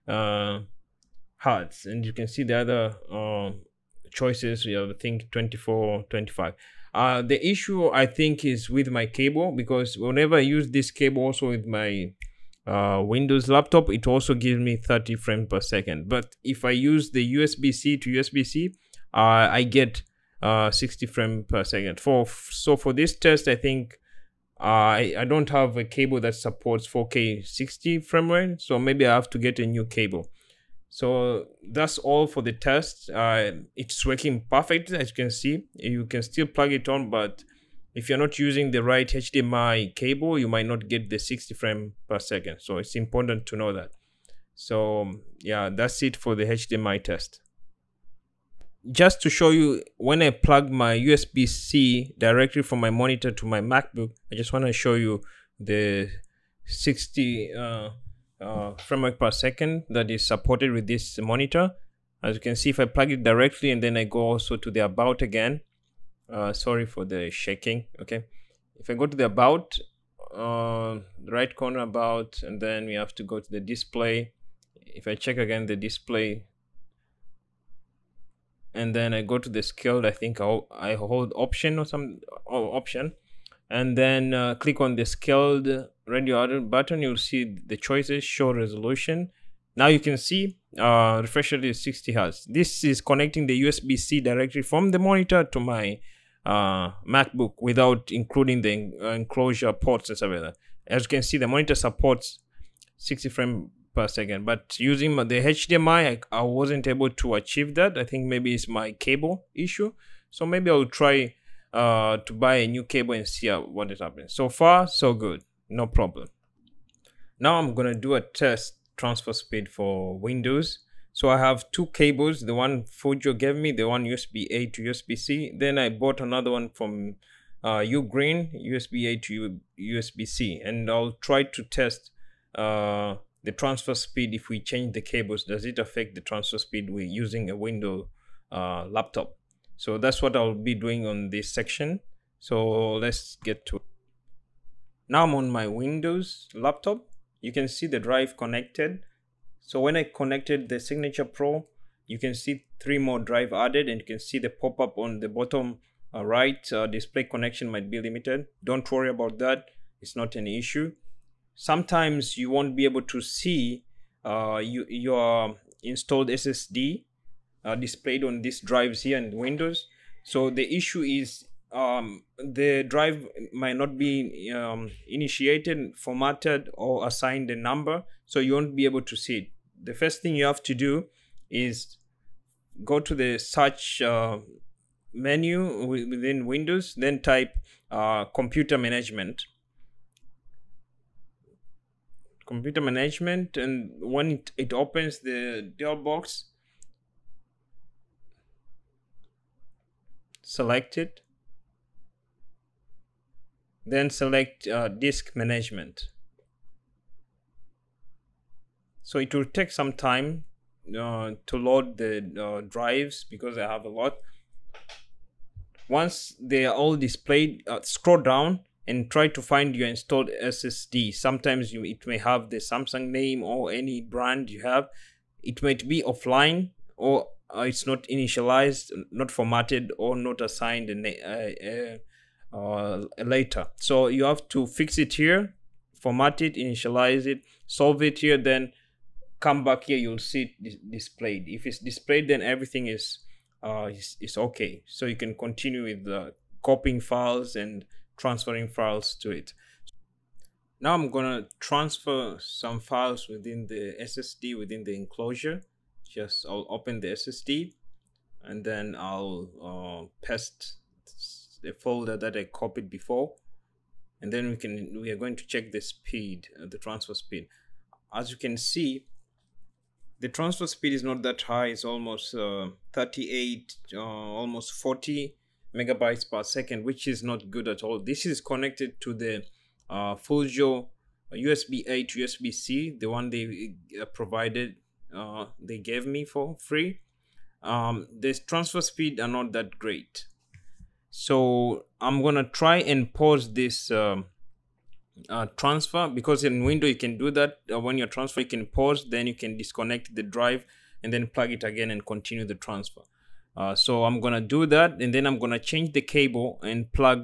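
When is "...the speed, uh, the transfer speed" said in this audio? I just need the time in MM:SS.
04:25.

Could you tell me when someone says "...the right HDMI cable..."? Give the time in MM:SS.
00:38.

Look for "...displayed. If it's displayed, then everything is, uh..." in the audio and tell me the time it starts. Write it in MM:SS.
04:00.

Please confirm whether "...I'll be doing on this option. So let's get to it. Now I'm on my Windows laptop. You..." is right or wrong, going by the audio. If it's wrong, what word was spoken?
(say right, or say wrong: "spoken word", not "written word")
wrong: "section", not "option".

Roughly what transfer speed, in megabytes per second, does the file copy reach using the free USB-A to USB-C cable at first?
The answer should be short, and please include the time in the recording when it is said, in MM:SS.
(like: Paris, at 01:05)
38 MB/s, at 04:32.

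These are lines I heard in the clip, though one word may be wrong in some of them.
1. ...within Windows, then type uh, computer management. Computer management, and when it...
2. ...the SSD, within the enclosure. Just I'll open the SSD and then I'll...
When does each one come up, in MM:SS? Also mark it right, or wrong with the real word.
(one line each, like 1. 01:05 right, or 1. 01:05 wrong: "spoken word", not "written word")
1. 03:05 right
2. 04:13 right.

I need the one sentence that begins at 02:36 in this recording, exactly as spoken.
Uh, display connection might be limited.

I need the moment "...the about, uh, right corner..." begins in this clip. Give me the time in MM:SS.
01:09.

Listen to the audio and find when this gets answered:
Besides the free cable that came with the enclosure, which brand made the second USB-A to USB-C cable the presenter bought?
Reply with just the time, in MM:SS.
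02:07.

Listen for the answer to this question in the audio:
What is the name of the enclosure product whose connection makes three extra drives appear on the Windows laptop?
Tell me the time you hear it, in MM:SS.
02:30.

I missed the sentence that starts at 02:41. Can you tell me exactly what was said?
Sometimes you won't be able to see uh, you, your installed SSD uh, displayed on these drives here in Windows.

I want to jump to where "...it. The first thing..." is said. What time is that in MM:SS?
02:59.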